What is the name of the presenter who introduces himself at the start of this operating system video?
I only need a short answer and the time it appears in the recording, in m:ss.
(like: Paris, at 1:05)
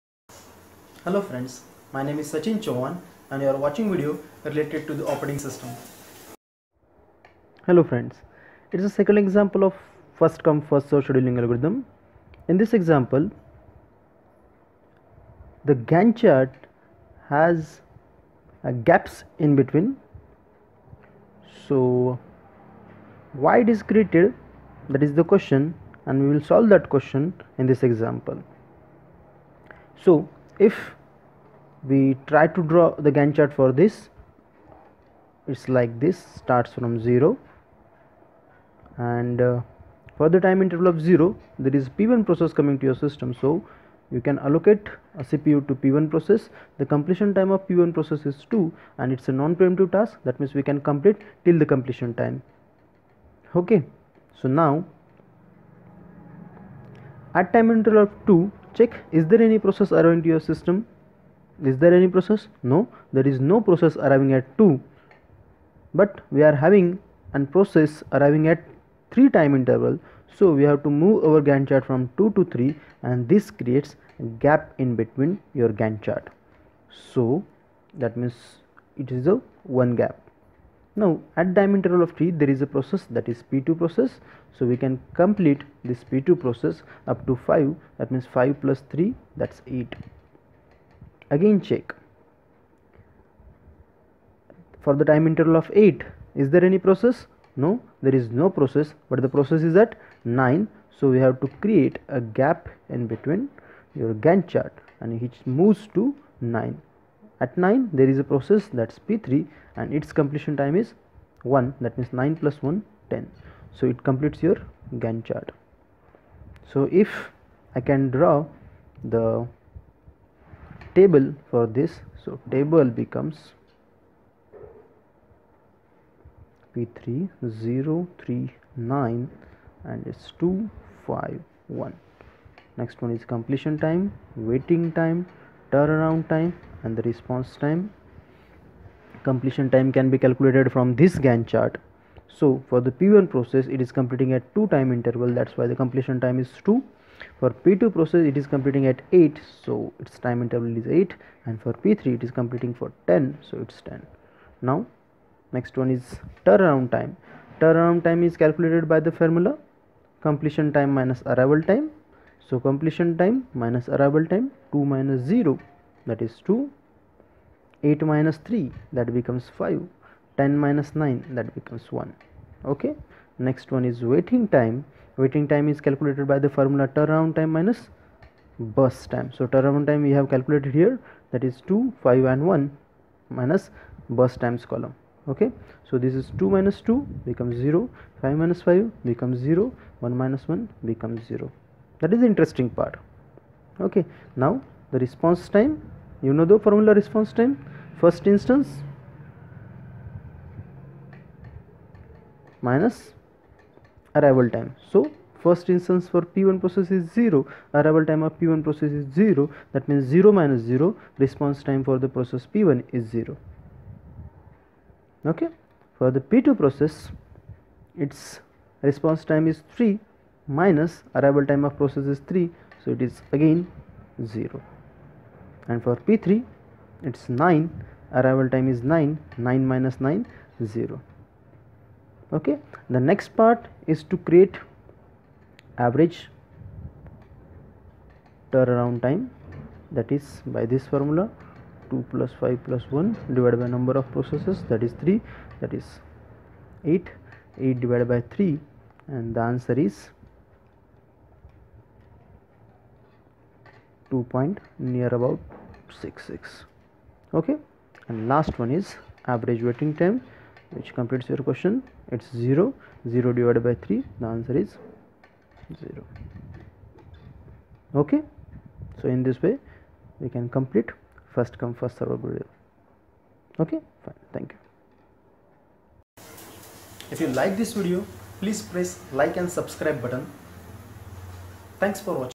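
Sachin Chavhan, at 0:02.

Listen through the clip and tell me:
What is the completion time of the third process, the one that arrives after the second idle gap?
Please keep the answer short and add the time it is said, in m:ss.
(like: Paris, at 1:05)
10, at 1:52.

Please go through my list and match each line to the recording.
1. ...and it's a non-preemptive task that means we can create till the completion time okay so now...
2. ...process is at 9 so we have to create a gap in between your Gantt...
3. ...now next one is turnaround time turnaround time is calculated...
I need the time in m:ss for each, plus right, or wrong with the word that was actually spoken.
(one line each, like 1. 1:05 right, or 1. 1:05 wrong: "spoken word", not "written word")
1. 0:48 wrong: "complete", not "create"
2. 1:39 right
3. 2:34 right.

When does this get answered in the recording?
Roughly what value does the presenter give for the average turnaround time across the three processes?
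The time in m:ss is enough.
4:14.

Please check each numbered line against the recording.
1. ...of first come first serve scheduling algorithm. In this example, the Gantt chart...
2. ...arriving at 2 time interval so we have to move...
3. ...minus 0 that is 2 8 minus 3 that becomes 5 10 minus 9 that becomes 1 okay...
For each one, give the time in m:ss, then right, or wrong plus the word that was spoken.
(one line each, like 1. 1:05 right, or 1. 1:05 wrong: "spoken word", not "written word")
1. 0:09 right
2. 1:08 wrong: "3", not "2"
3. 2:44 right.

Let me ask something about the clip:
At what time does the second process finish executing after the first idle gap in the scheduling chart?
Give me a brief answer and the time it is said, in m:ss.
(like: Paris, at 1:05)
8, at 1:28.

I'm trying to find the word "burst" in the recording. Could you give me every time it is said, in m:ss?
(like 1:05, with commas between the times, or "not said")
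2:58, 3:04.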